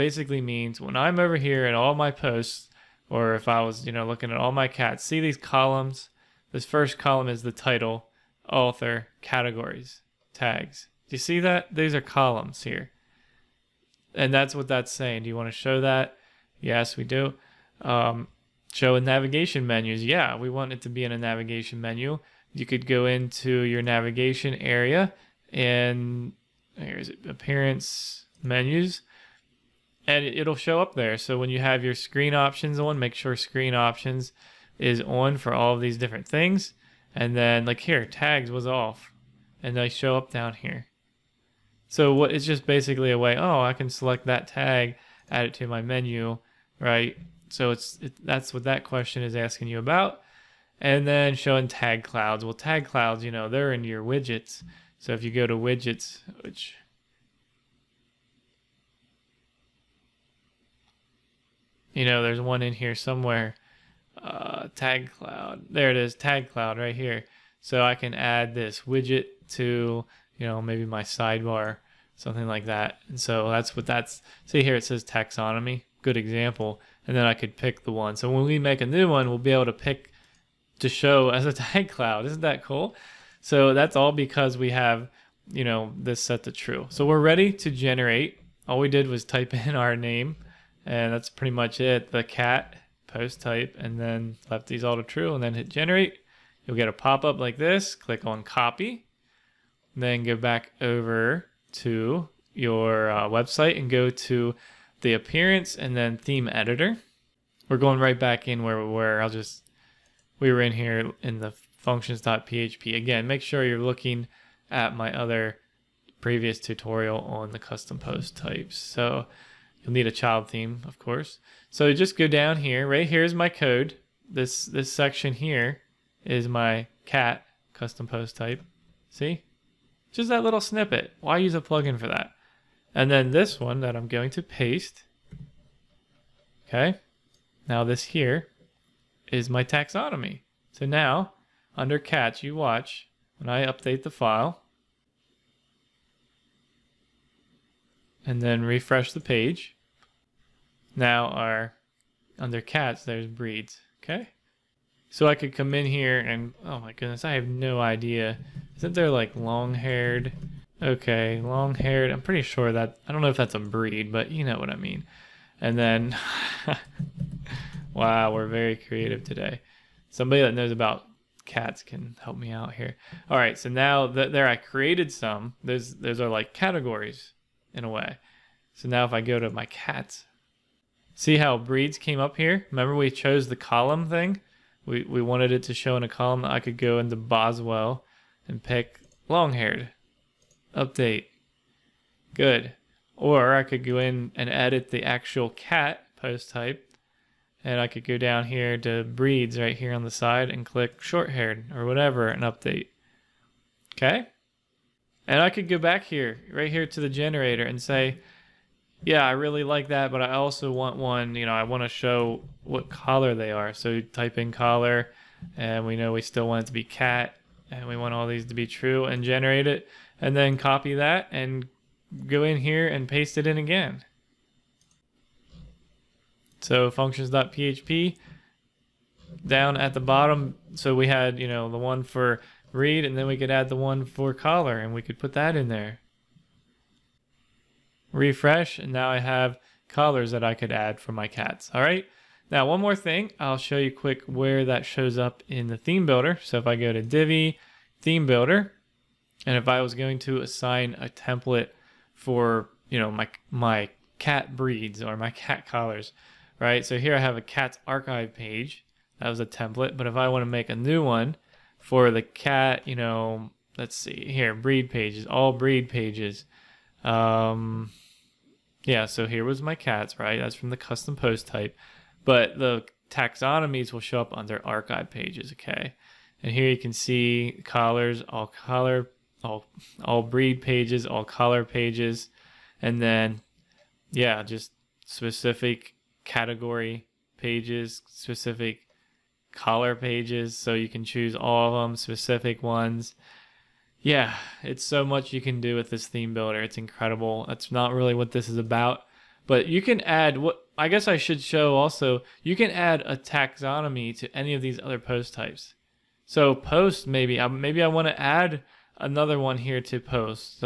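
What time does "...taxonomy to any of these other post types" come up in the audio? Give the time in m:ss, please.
5:03.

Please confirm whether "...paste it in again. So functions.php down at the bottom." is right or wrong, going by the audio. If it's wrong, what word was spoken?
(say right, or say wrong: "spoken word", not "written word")
right.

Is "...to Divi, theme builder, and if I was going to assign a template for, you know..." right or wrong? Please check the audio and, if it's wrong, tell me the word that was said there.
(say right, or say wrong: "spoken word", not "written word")
right.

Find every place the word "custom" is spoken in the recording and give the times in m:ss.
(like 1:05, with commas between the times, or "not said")
1:57, 2:07, 4:30.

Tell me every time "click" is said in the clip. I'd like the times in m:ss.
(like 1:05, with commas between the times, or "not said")
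1:37, 3:20.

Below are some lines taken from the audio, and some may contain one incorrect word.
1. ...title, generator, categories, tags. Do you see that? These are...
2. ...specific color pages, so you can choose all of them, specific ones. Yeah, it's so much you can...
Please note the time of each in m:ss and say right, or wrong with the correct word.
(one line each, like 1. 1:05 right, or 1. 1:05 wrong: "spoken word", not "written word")
1. 0:07 wrong: "author", not "generator"
2. 4:48 right.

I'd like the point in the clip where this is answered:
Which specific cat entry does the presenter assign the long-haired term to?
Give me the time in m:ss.
3:07.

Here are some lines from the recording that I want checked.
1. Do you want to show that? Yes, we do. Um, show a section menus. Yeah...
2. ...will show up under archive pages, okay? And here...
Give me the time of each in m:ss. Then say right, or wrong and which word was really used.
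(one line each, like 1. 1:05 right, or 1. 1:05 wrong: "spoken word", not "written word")
1. 0:15 wrong: "navigation", not "section"
2. 4:33 right.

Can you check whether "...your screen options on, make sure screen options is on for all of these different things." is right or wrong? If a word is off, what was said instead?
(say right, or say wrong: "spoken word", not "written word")
right.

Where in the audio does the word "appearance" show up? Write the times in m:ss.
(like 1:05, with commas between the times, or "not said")
0:27, 1:45.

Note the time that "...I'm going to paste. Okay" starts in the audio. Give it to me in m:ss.
2:13.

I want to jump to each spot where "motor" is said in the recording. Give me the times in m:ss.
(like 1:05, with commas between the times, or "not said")
not said.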